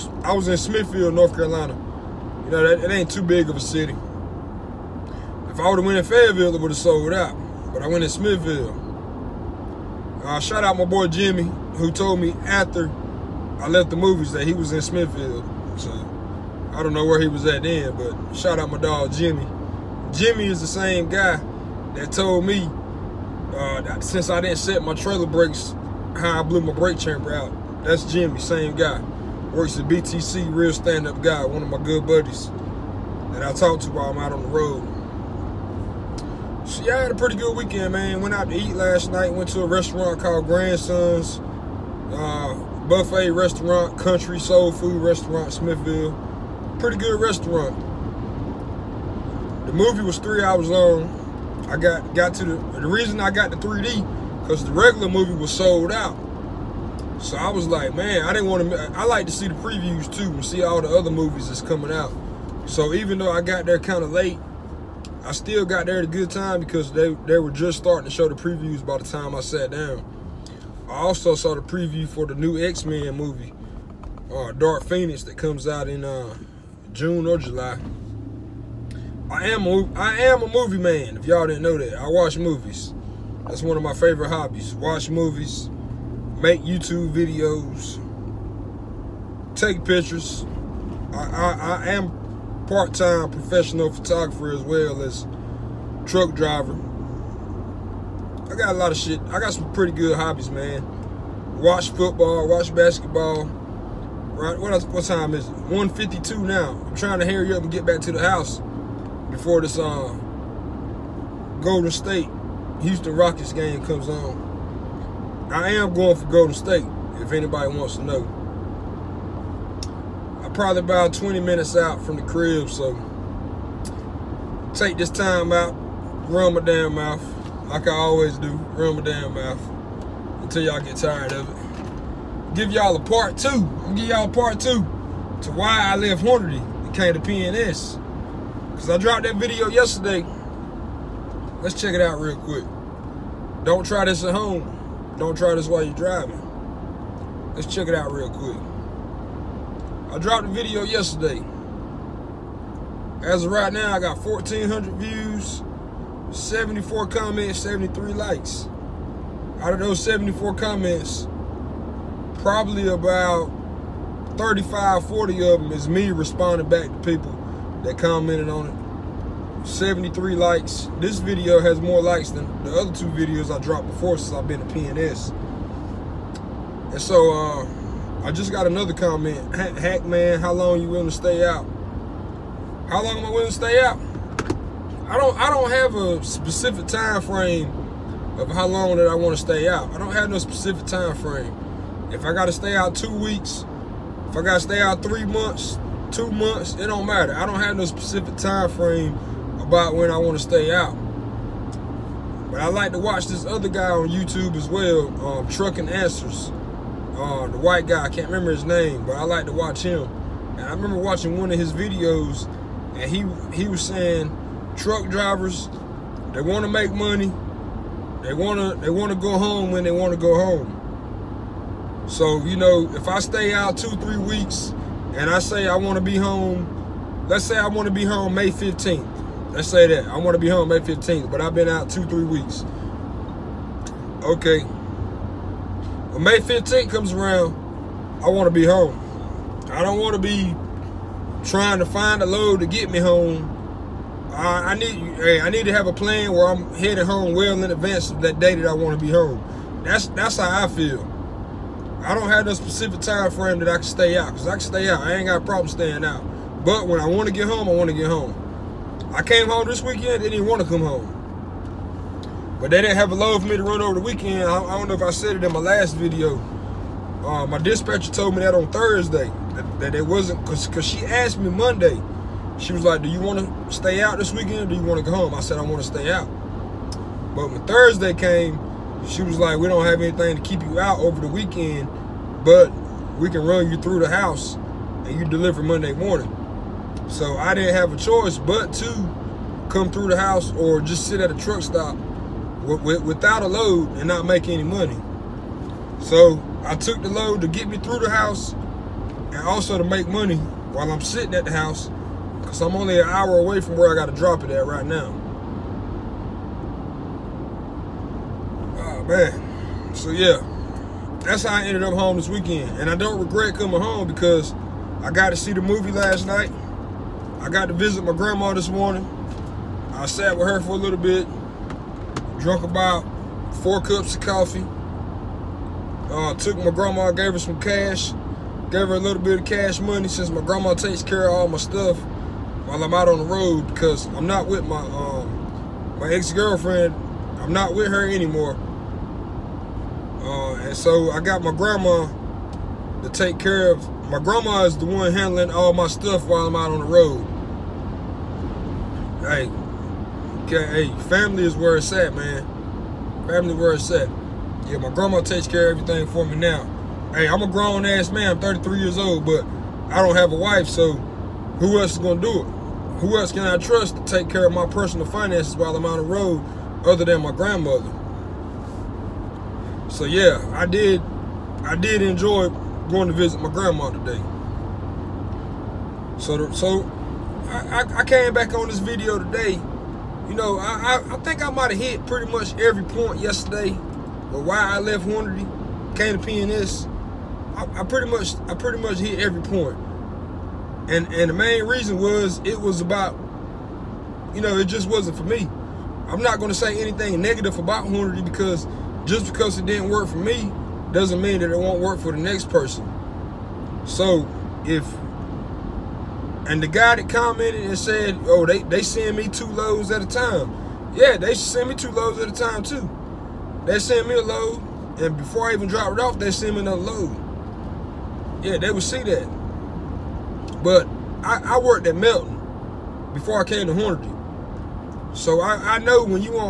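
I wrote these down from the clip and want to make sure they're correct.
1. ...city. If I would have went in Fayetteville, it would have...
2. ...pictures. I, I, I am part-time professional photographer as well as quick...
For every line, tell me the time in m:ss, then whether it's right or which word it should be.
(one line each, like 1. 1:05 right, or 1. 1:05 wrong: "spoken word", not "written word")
1. 0:03 right
2. 1:29 wrong: "truck", not "quick".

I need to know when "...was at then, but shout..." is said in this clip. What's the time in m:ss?
0:17.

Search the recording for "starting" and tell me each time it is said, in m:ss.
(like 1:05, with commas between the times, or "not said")
1:07.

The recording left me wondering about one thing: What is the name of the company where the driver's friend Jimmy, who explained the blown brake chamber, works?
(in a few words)
BTC.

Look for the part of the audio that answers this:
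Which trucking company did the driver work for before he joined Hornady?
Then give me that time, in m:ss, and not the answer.
7:01.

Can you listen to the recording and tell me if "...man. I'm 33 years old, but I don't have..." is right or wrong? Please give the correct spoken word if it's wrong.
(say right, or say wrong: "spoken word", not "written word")
right.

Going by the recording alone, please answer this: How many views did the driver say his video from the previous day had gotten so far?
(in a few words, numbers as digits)
1,400.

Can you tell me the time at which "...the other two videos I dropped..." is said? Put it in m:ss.
2:52.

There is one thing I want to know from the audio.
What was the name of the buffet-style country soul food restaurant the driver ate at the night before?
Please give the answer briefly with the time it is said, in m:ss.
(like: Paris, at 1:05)
Grandsons, at 0:40.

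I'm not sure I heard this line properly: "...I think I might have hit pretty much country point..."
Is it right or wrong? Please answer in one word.
wrong.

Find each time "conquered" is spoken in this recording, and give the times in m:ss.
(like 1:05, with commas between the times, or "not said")
not said.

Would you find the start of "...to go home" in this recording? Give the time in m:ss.
4:35.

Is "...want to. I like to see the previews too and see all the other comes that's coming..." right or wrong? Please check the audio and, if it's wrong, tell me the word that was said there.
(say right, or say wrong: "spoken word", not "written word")
wrong: "movies", not "comes".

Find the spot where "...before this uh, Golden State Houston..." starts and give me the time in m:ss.
1:49.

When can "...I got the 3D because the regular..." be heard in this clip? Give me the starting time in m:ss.
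0:53.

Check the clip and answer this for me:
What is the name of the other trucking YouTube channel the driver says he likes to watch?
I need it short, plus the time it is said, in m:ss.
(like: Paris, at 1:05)
Trucking Answers, at 3:25.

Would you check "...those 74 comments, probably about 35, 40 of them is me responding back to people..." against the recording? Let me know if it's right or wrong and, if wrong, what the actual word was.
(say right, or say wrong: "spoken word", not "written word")
right.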